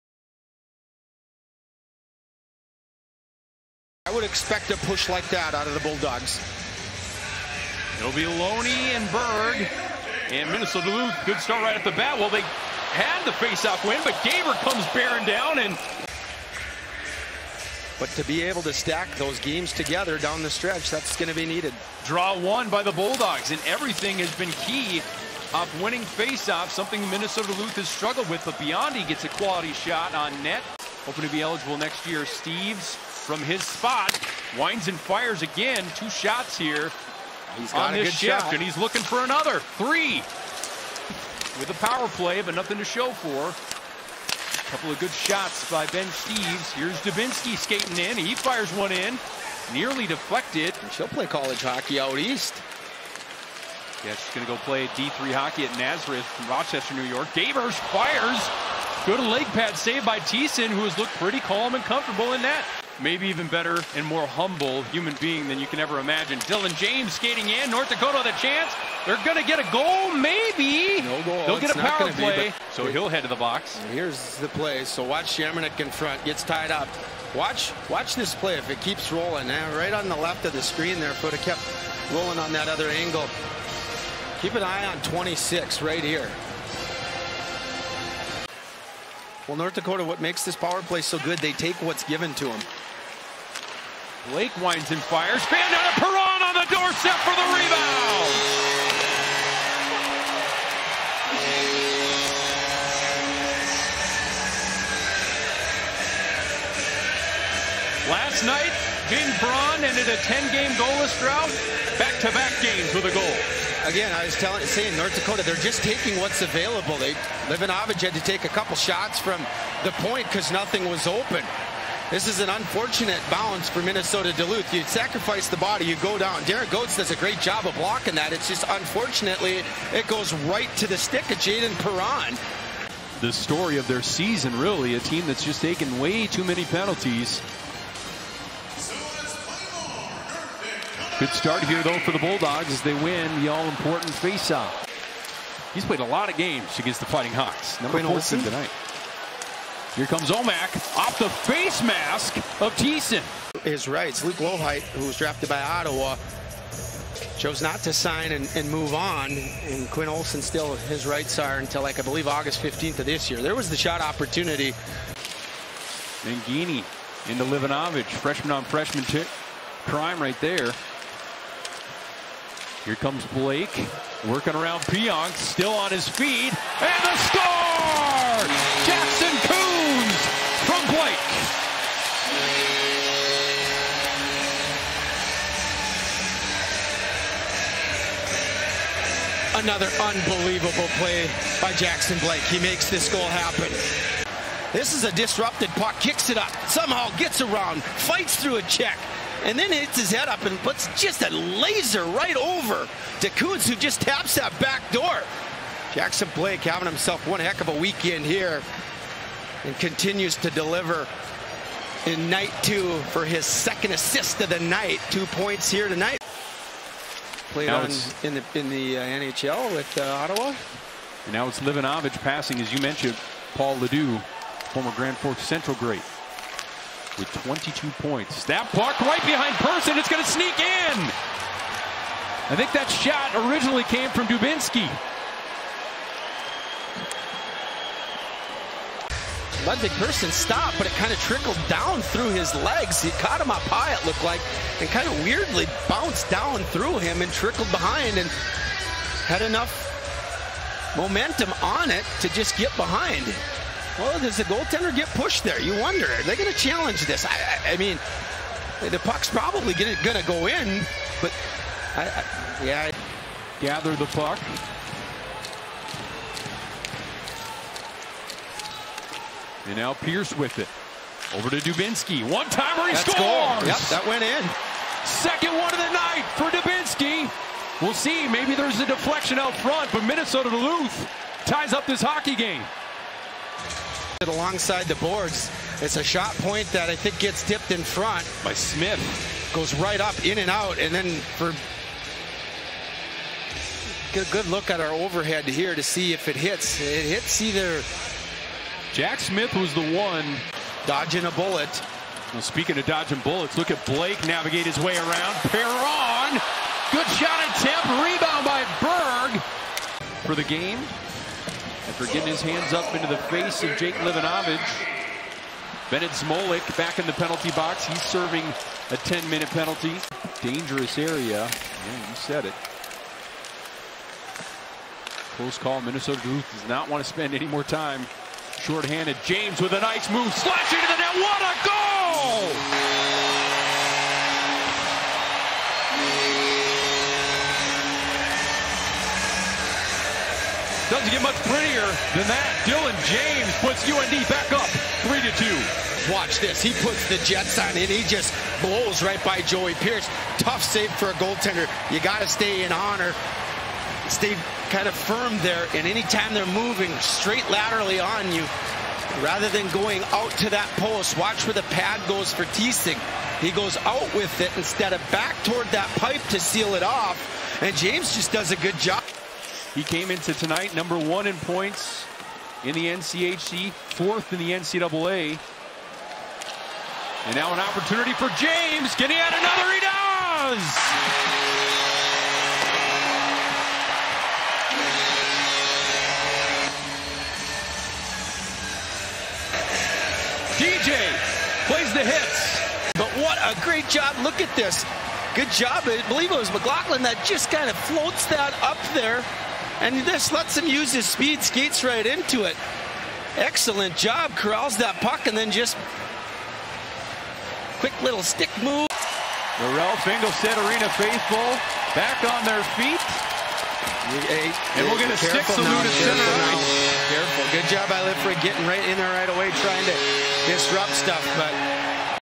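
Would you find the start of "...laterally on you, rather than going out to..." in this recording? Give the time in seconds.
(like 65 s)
357 s.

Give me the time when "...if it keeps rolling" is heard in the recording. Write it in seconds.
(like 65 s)
78 s.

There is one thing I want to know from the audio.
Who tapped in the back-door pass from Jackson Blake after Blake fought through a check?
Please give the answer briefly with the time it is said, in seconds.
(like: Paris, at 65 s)
Coons, at 203 s.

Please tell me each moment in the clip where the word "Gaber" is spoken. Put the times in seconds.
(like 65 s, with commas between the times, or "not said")
14 s, 57 s.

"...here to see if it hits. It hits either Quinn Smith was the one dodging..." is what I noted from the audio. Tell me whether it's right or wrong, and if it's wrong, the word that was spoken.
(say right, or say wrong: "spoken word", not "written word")
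wrong: "Jack", not "Quinn".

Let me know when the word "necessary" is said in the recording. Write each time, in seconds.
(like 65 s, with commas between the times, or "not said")
not said.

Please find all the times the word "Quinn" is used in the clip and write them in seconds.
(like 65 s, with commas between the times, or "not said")
148 s, 159 s.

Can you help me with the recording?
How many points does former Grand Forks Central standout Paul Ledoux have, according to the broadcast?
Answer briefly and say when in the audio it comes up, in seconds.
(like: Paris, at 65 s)
22, at 227 s.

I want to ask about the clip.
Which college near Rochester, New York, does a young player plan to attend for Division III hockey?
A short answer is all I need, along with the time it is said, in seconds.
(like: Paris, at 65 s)
Nazareth, at 55 s.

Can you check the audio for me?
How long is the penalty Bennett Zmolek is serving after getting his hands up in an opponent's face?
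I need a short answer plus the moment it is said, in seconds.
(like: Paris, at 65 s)
10 minutes, at 318 s.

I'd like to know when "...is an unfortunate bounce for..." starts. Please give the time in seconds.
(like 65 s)
122 s.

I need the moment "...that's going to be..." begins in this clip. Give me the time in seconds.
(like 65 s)
20 s.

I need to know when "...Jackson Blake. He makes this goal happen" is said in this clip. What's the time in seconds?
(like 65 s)
191 s.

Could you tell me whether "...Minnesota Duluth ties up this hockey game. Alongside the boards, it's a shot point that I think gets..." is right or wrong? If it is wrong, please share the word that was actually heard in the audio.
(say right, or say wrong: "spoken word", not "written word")
right.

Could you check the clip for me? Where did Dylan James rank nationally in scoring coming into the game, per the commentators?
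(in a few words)
Fourth in the NCAA.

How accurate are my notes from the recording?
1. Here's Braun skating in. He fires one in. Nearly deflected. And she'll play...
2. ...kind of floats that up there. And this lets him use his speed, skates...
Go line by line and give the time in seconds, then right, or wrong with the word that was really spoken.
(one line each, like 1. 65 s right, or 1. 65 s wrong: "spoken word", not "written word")
1. 46 s wrong: "Dubinsky", not "Braun"
2. 397 s right.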